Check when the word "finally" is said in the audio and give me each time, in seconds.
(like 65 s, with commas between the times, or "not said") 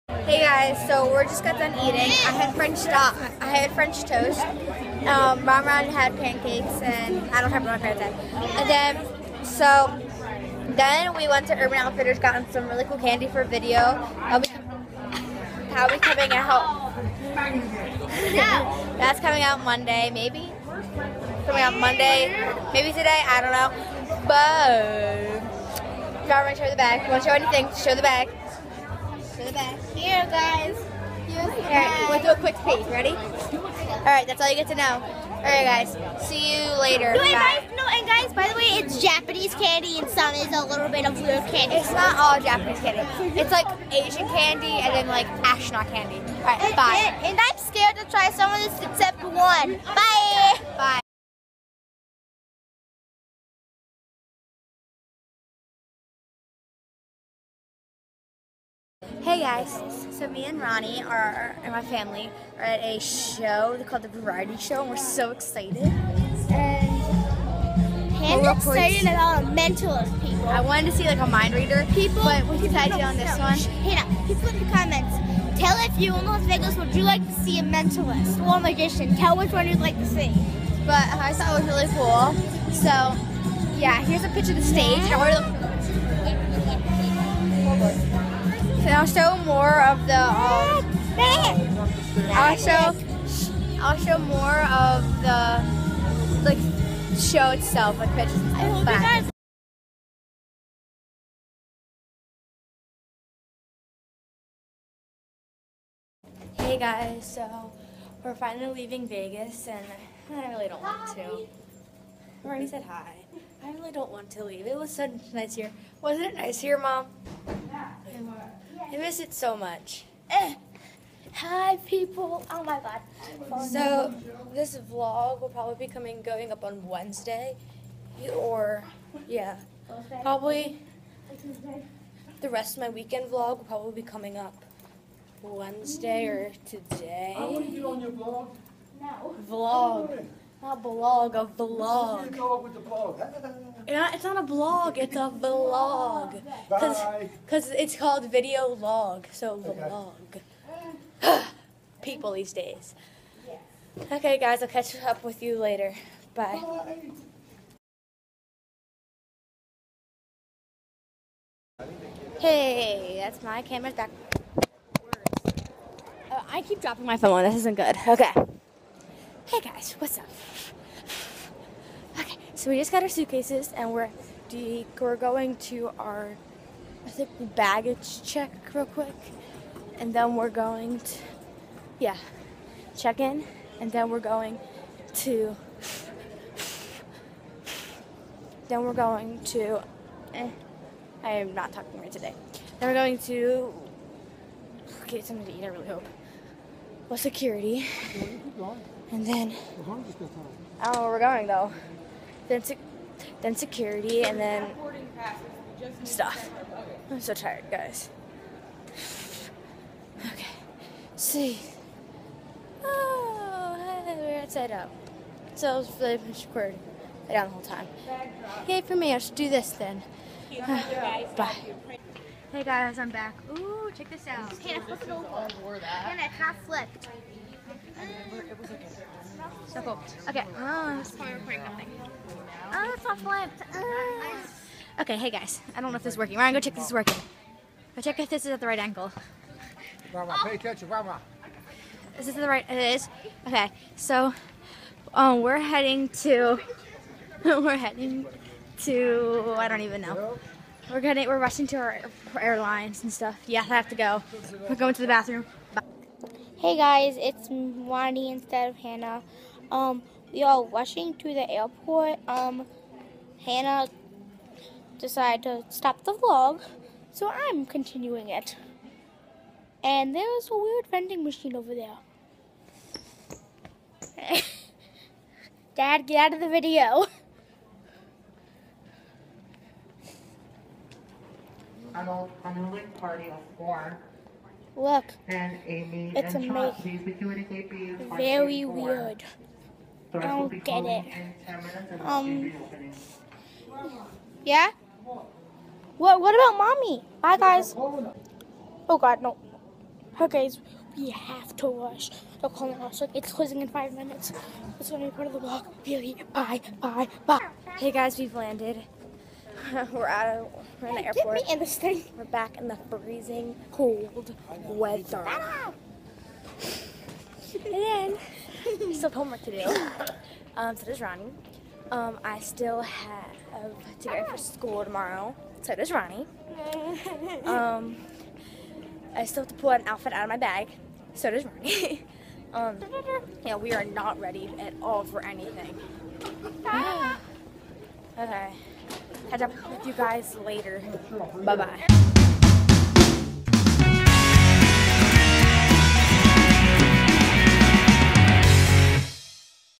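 108 s.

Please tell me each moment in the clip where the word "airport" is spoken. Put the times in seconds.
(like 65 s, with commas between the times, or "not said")
261 s, 311 s.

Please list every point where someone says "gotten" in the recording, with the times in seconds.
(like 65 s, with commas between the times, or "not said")
12 s.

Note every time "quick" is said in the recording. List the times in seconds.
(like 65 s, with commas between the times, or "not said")
32 s, 178 s.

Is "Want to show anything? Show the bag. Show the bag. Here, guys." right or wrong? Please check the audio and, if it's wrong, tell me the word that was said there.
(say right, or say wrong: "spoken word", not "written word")
right.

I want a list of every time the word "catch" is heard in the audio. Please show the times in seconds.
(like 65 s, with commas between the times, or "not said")
154 s, 339 s.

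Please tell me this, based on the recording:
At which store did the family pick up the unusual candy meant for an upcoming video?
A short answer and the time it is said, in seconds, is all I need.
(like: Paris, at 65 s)
Urban Outfitters, at 11 s.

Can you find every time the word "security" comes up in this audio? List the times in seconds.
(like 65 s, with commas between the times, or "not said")
197 s, 203 s.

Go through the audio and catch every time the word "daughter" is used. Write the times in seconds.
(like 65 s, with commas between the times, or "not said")
not said.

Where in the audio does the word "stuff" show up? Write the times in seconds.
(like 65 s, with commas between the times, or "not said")
206 s, 253 s.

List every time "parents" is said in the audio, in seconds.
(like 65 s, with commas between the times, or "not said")
7 s.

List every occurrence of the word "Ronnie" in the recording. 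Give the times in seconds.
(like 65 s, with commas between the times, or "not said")
60 s, 257 s, 320 s, 325 s, 331 s.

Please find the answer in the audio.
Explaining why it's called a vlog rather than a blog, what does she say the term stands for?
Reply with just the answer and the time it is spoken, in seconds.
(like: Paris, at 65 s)
video log, at 148 s.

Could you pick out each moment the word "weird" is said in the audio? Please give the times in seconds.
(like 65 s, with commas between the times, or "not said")
270 s, 288 s.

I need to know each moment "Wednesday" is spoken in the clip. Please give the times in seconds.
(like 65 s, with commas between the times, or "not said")
126 s, 135 s.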